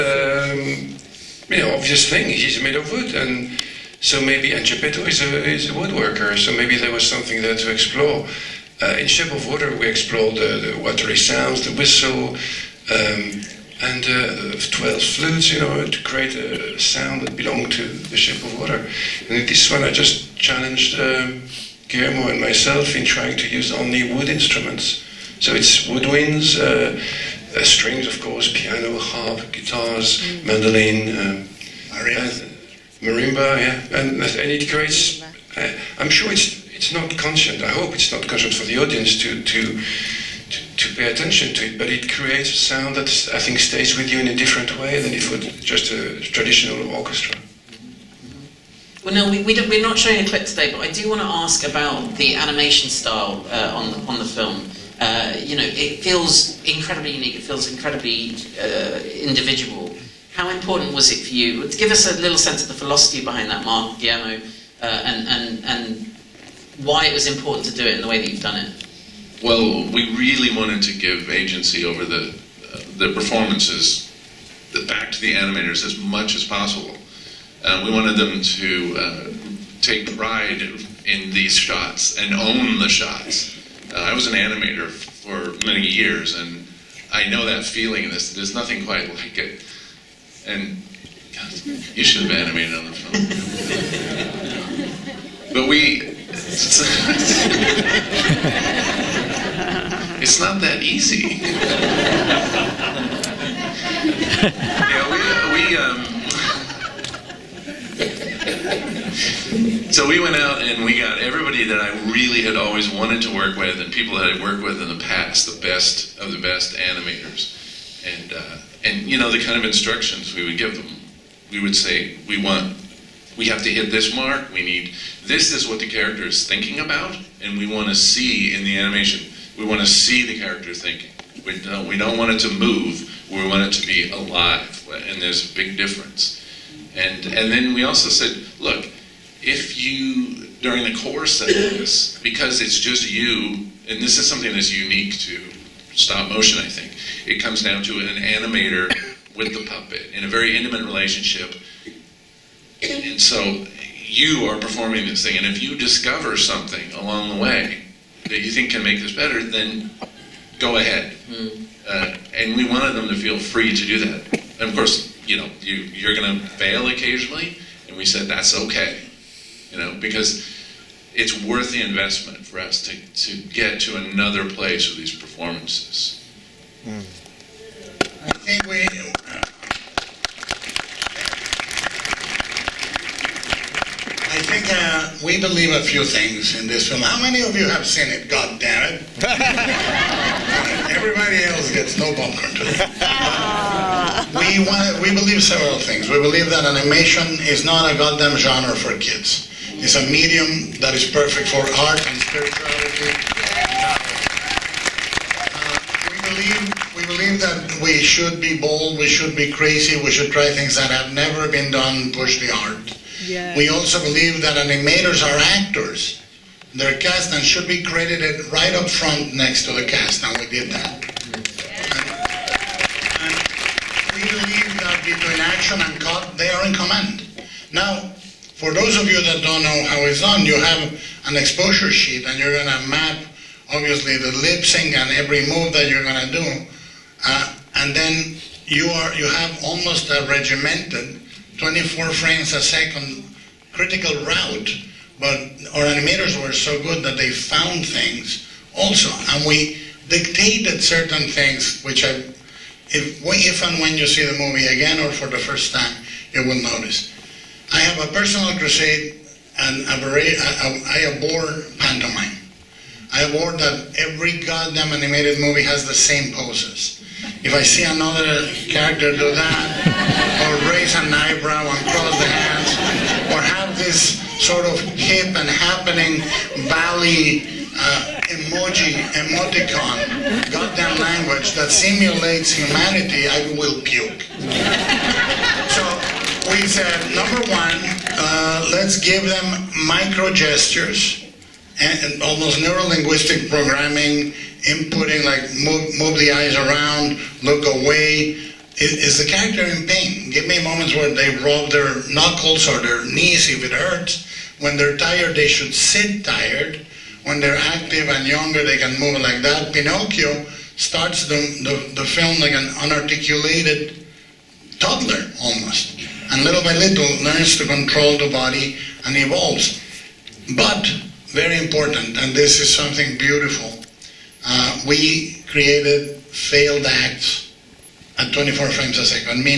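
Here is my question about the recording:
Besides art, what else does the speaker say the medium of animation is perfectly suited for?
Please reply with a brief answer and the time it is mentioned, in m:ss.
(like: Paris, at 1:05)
spirituality, at 3:22.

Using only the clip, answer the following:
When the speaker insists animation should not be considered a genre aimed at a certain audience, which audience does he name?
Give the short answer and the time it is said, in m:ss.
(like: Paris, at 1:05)
kids, at 3:18.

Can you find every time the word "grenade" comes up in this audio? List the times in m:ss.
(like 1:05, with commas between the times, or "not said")
not said.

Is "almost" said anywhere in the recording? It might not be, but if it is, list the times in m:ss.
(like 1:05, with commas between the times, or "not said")
3:59, 4:52, 5:15.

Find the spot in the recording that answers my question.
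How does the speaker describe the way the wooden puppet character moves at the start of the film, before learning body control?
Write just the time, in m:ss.
5:12.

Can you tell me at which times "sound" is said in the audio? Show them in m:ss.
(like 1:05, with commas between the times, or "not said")
0:11, 0:16, 0:42.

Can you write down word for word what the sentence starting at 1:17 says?
Uh, we wanted them to uh, take pride in these shots and own the shots.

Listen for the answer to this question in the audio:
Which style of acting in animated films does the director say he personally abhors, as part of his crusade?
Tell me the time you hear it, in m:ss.
4:21.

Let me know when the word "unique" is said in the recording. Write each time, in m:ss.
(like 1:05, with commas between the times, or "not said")
0:57, 2:24.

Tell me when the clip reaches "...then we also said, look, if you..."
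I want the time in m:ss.
2:17.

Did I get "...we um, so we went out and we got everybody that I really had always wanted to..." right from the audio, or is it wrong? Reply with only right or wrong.
right.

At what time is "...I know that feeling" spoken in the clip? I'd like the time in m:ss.
1:27.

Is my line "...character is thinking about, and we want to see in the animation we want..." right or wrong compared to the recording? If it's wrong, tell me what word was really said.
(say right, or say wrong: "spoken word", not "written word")
right.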